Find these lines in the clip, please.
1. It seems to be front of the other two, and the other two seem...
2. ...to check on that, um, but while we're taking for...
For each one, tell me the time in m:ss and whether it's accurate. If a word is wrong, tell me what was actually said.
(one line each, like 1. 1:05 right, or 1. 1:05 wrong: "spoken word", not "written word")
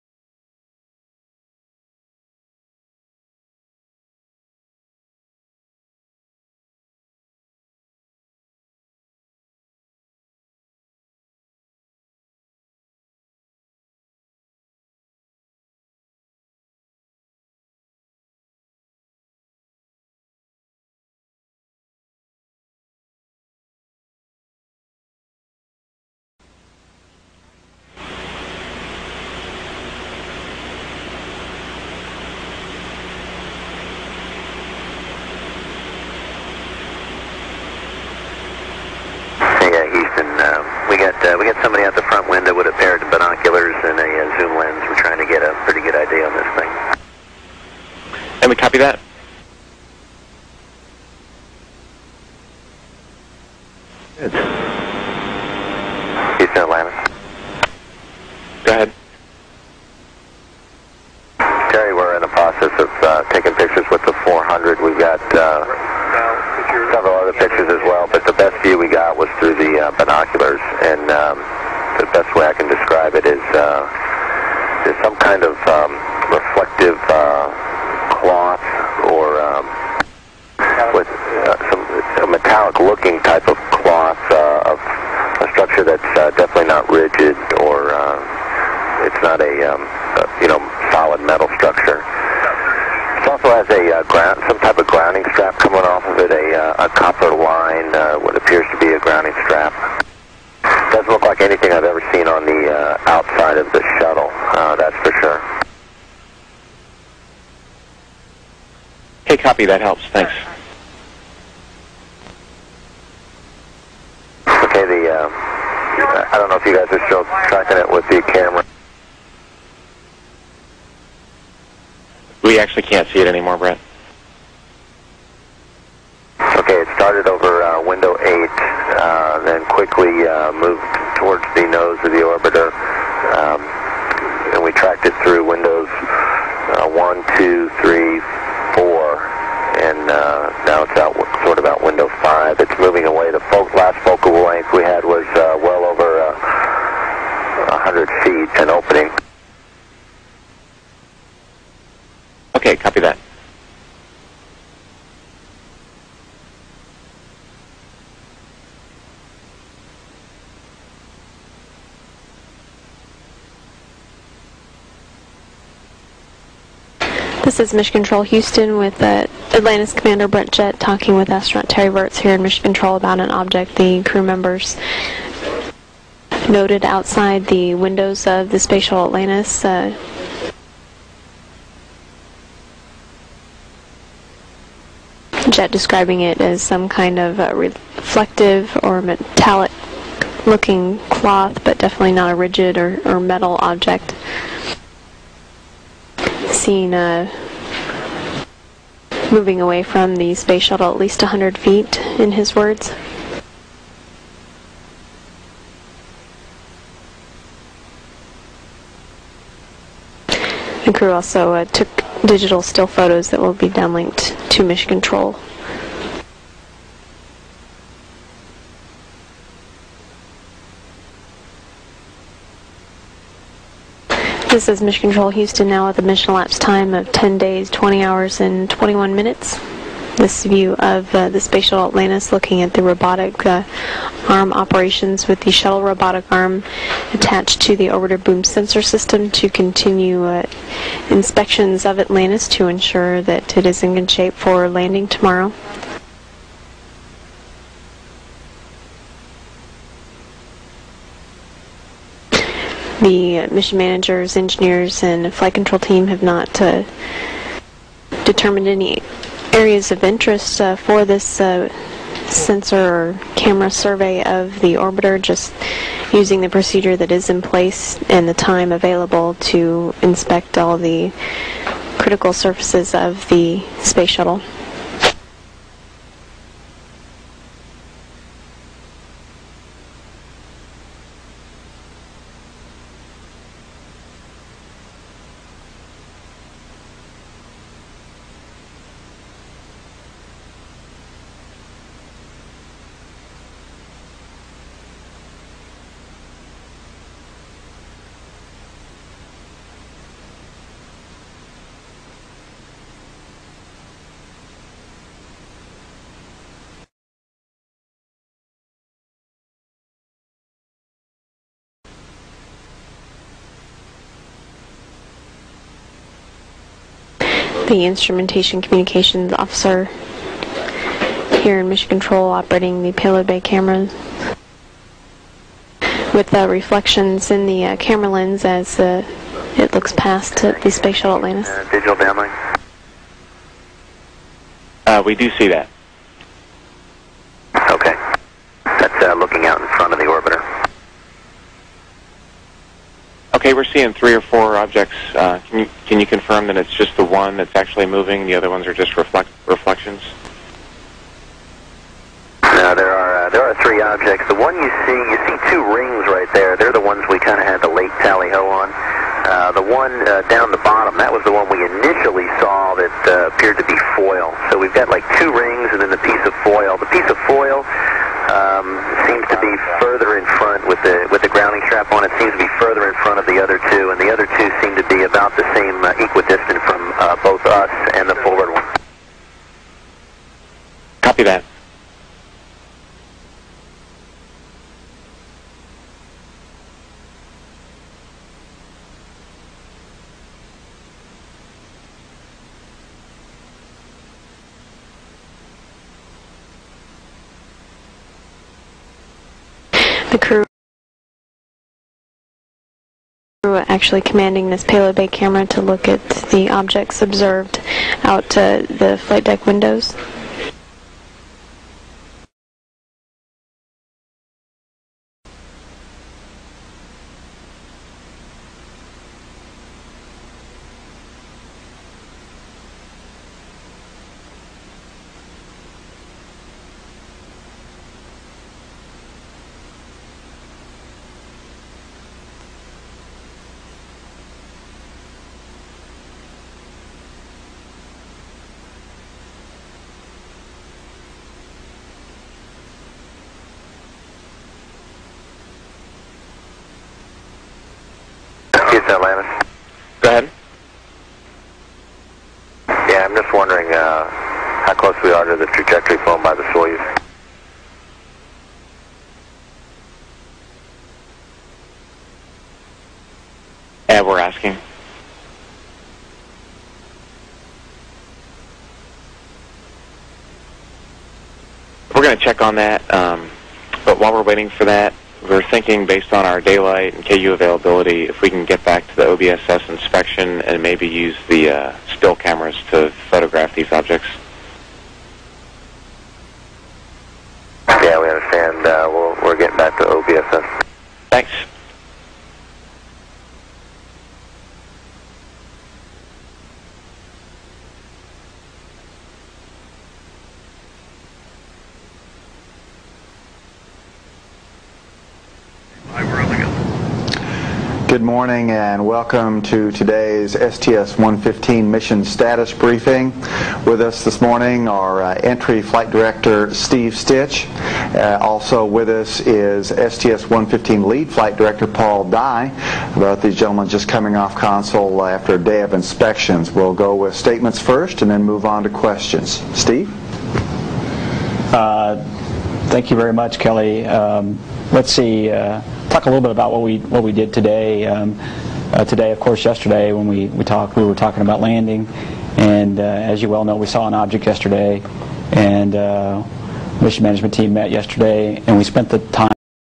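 1. 6:12 right
2. 7:52 wrong: "waiting", not "taking".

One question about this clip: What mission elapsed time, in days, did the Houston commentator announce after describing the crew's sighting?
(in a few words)
10 days.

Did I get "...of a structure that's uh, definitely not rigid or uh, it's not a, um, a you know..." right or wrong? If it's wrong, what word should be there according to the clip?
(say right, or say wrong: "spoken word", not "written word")
right.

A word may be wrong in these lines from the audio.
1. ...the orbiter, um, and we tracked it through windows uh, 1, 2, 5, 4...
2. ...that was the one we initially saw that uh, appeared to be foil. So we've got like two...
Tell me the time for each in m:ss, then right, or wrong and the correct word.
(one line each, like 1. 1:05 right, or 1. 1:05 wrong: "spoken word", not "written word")
1. 2:12 wrong: "3", not "5"
2. 6:00 right.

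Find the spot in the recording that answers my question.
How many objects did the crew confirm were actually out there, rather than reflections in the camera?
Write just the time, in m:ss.
5:53.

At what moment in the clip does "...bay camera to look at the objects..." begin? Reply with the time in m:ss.
6:44.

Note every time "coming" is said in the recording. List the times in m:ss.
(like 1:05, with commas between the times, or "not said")
1:35, 8:43.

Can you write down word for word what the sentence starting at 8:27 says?
Good morning and welcome to today's STS-115 mission status briefing.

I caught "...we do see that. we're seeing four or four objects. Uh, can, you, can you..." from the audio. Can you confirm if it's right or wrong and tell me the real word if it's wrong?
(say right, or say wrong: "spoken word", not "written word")
wrong: "three", not "four".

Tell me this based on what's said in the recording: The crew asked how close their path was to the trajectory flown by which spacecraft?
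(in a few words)
Soyuz.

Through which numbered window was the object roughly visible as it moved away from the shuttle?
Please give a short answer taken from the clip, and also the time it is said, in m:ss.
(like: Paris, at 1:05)
5, at 2:21.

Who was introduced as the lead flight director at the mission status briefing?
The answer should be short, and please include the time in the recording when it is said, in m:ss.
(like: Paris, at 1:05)
Paul Dye, at 8:41.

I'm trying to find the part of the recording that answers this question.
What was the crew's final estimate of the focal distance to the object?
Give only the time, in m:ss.
2:25.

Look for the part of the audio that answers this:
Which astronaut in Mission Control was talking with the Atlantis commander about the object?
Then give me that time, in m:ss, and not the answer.
2:51.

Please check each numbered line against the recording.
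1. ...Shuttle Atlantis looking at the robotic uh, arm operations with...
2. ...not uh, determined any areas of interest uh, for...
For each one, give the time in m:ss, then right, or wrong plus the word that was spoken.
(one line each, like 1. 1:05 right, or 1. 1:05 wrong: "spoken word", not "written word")
1. 3:51 right
2. 4:16 right.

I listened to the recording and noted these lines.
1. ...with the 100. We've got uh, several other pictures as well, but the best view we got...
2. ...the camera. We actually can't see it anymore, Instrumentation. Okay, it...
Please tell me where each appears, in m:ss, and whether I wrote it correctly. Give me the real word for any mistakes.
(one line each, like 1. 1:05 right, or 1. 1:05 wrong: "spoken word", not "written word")
1. 1:03 wrong: "400", not "100"
2. 1:58 wrong: "Brent", not "Instrumentation".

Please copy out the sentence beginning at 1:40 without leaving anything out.
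Doesn't look like anything I've ever seen on the uh, outside of the shuttle, uh, that's for sure.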